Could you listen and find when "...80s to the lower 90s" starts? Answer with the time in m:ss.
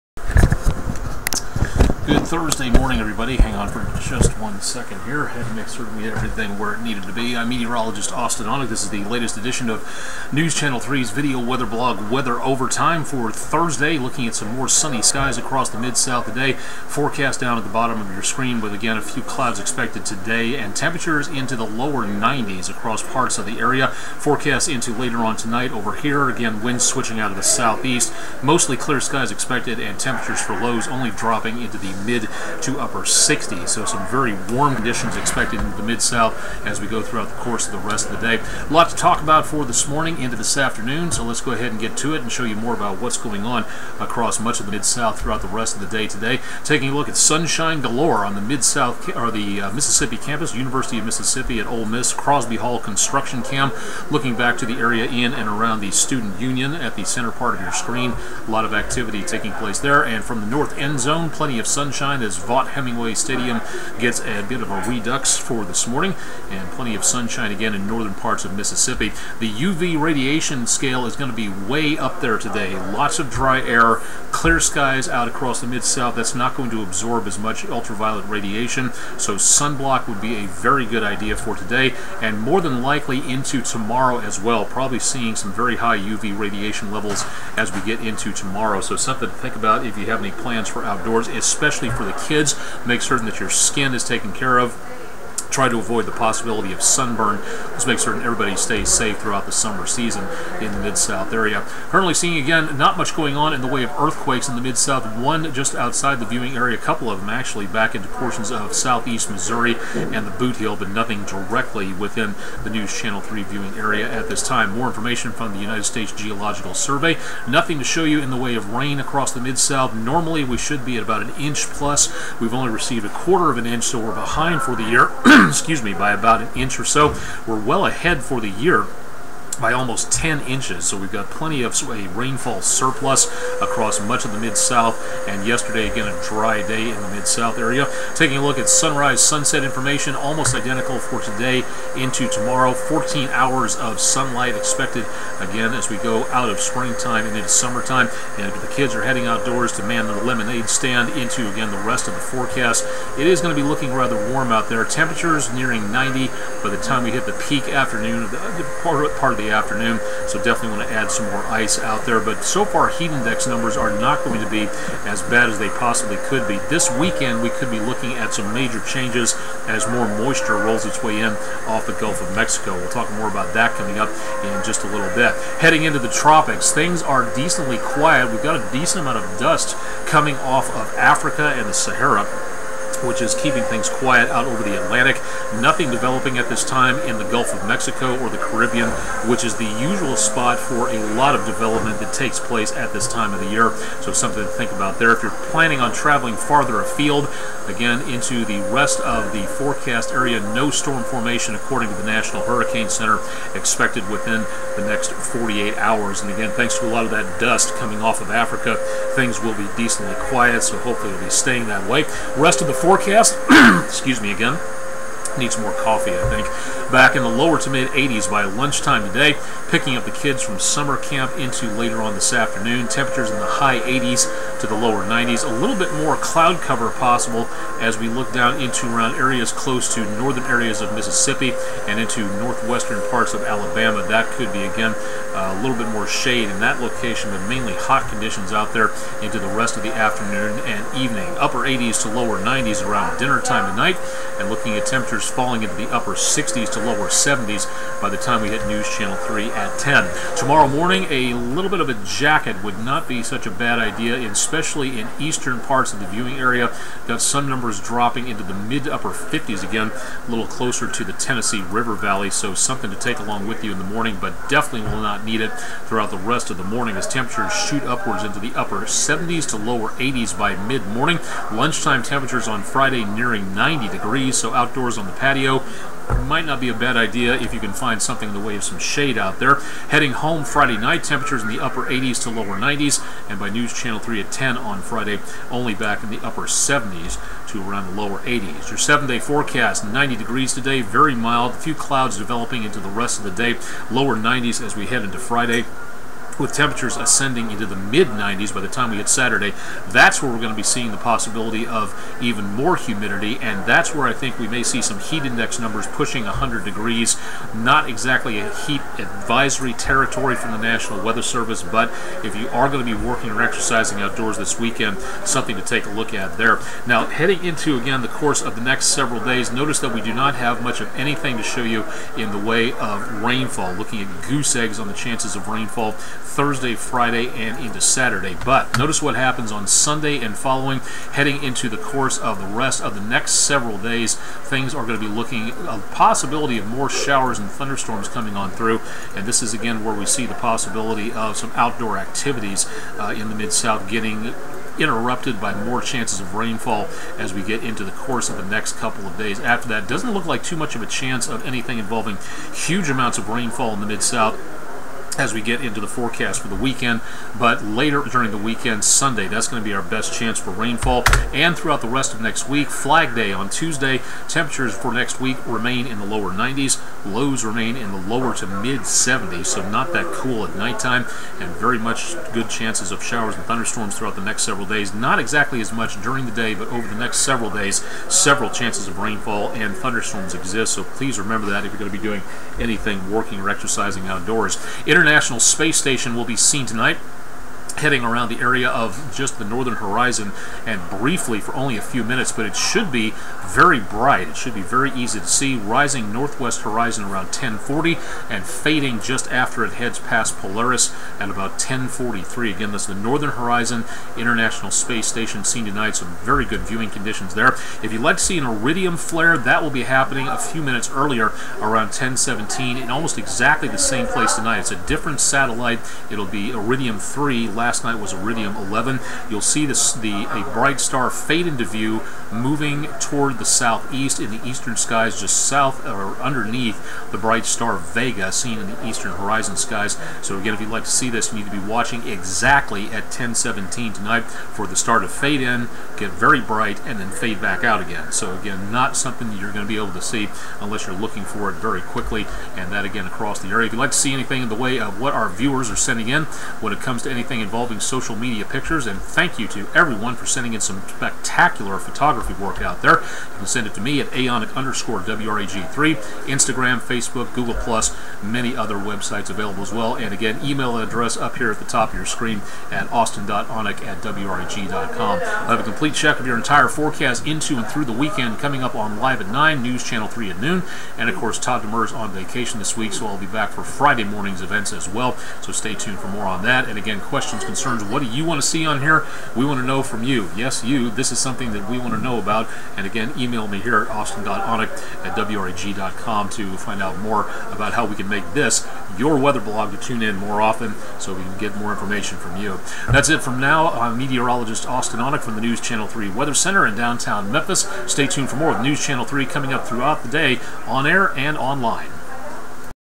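3:43.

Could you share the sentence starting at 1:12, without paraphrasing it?
Lots of dry air, clear skies out across the mid-south.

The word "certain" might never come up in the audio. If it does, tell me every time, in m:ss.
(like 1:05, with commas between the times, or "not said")
1:33, 1:37.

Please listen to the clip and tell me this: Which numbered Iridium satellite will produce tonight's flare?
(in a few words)
Iridium 3.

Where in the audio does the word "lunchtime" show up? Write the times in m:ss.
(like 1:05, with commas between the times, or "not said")
3:38, 4:31.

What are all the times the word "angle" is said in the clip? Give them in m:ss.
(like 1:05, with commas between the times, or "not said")
not said.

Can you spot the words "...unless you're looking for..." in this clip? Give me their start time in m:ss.
7:20.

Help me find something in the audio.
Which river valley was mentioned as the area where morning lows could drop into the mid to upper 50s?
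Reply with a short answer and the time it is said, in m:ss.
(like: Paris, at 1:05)
Tennessee River Valley, at 4:21.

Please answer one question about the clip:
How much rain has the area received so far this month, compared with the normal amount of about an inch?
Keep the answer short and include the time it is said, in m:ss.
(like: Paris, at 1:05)
a quarter of an inch, at 2:03.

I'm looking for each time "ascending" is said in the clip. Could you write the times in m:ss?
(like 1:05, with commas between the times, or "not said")
4:56.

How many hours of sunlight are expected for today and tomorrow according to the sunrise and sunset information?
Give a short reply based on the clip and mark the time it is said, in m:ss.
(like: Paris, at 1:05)
14 hours, at 2:22.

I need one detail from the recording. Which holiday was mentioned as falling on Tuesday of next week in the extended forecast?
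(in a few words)
Flag Day.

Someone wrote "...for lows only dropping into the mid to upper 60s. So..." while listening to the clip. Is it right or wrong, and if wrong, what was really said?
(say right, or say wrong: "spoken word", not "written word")
right.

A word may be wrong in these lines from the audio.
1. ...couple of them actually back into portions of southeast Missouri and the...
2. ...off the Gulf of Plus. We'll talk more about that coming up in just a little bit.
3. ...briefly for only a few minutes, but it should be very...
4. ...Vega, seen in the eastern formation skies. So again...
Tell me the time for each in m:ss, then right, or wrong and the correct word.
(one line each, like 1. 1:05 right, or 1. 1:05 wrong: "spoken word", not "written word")
1. 1:46 right
2. 2:51 wrong: "Mexico", not "Plus"
3. 6:30 right
4. 7:07 wrong: "horizon", not "formation".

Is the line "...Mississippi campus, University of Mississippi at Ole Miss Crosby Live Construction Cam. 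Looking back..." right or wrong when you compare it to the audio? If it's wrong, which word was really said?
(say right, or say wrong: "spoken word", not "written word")
wrong: "Hall", not "Live".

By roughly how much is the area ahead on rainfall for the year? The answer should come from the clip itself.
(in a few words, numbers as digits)
almost 10 inches.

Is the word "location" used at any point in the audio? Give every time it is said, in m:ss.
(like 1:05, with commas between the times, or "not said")
3:56.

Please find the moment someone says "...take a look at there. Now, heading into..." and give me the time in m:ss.
5:15.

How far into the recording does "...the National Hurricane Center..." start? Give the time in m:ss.
3:21.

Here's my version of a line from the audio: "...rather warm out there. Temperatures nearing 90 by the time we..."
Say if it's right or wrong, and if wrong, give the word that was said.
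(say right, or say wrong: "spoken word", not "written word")
right.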